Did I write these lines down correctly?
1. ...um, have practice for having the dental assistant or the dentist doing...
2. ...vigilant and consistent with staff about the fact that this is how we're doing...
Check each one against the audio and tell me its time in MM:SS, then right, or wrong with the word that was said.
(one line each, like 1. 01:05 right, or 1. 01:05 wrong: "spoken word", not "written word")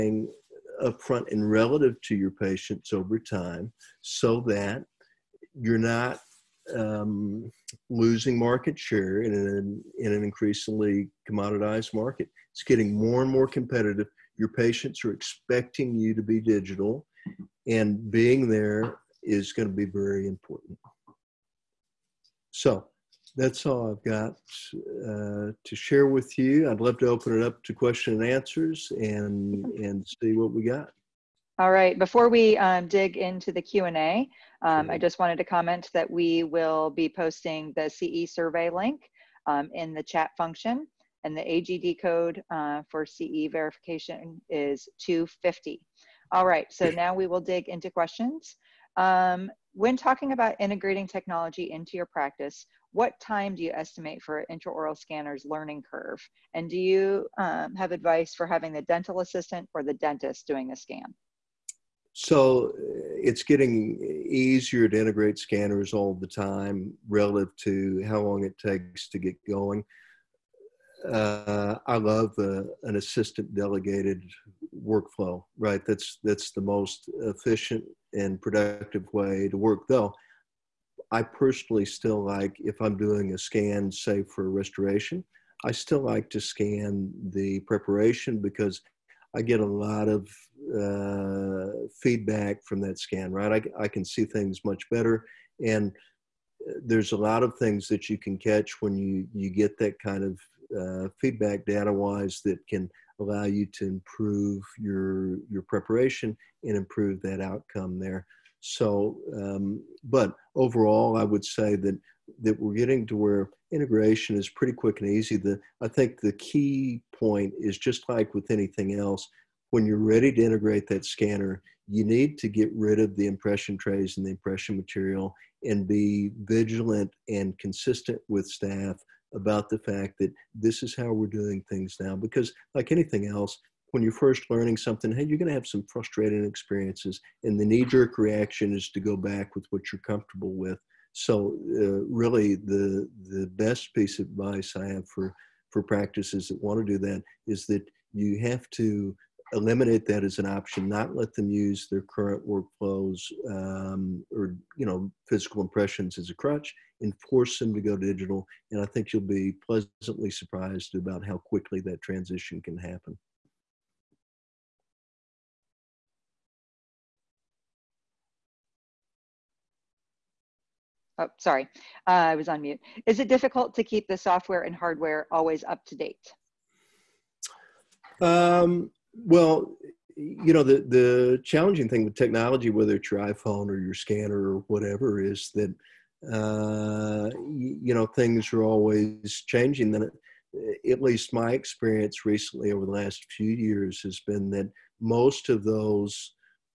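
1. 00:57 wrong: "advice", not "practice"
2. 02:06 right.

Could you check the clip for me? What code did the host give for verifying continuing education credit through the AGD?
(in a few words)
250.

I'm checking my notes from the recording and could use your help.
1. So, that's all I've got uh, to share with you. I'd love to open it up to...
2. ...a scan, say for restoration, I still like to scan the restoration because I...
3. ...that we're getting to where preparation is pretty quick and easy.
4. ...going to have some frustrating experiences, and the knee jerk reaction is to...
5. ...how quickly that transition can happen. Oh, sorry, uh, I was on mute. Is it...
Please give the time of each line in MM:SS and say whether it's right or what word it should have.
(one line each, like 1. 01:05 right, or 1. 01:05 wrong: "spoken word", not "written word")
1. 00:22 right
2. 01:23 wrong: "preparation", not "restoration"
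3. 01:52 wrong: "integration", not "preparation"
4. 02:15 right
5. 02:41 right.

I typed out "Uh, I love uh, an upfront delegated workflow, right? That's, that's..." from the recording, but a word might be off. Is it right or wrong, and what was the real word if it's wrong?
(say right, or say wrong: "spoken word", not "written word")
wrong: "assistant", not "upfront".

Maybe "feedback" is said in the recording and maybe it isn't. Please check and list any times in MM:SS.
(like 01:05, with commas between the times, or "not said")
01:32, 01:41.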